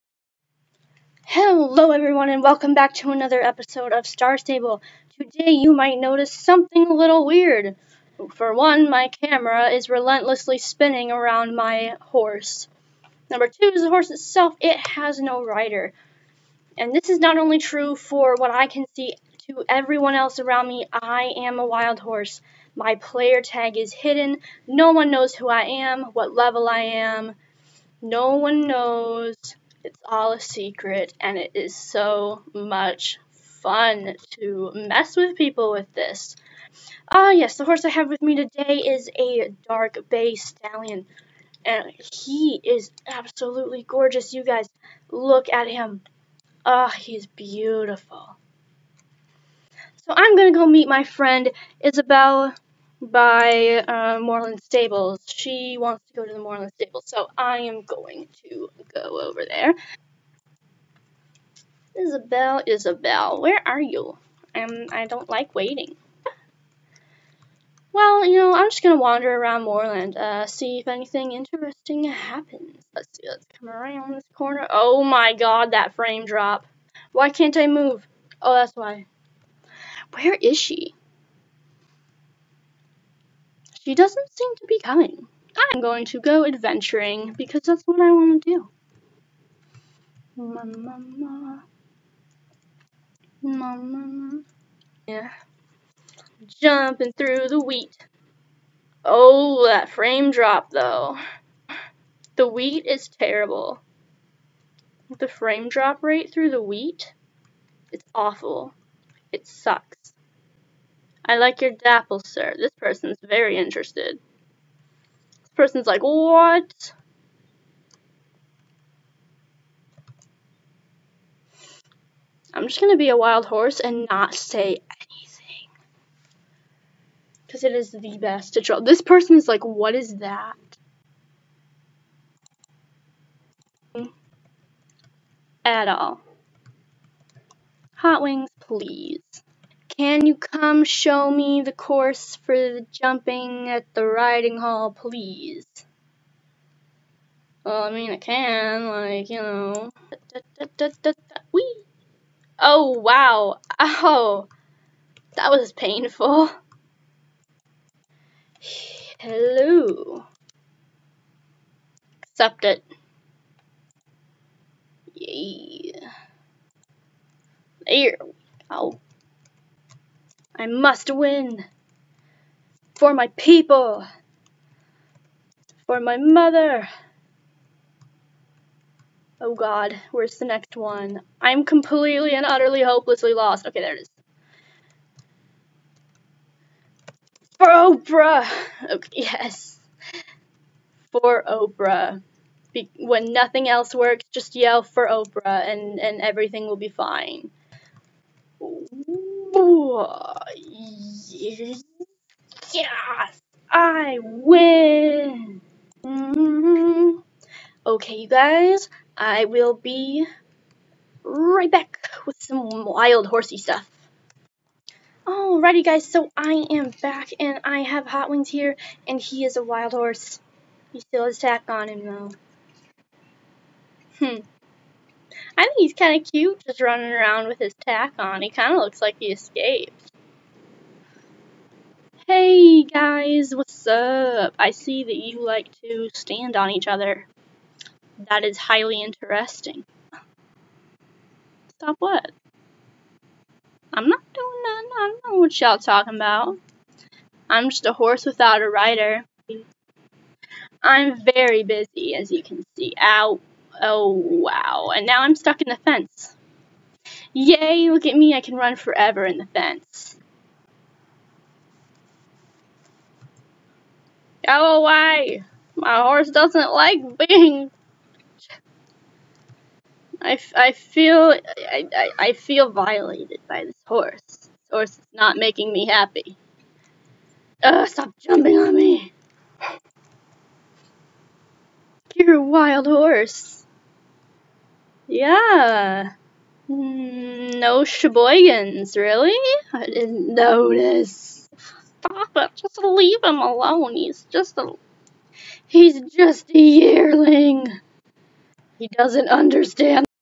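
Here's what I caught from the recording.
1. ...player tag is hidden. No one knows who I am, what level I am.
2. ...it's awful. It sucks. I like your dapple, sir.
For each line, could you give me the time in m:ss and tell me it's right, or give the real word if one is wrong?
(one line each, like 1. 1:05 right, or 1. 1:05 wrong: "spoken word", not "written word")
1. 0:22 right
2. 1:47 right.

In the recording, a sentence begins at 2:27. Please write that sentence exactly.
Well, I mean, I can, like, you know.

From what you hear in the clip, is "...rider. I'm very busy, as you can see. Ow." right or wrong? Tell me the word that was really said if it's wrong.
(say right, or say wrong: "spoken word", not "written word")
right.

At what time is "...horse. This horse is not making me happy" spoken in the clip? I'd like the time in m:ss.
4:33.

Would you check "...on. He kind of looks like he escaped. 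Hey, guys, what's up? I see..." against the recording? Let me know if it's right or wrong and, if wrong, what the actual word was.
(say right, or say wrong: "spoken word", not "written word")
right.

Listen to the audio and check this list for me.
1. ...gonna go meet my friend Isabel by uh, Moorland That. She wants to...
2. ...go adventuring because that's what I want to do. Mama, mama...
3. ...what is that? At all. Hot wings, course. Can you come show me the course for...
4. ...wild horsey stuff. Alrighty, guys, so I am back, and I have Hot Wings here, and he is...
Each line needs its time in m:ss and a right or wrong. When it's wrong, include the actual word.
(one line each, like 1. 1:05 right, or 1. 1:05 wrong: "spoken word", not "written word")
1. 0:50 wrong: "Stables", not "That"
2. 1:26 right
3. 2:09 wrong: "please", not "course"
4. 3:32 right.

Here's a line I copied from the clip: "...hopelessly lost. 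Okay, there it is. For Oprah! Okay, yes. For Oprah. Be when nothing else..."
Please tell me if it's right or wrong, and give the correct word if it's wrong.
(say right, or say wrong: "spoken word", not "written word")
right.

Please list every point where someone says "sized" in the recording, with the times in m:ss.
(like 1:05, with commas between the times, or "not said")
not said.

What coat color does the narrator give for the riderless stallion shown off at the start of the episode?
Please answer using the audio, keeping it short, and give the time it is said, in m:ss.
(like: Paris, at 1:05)
Dark bay, at 0:39.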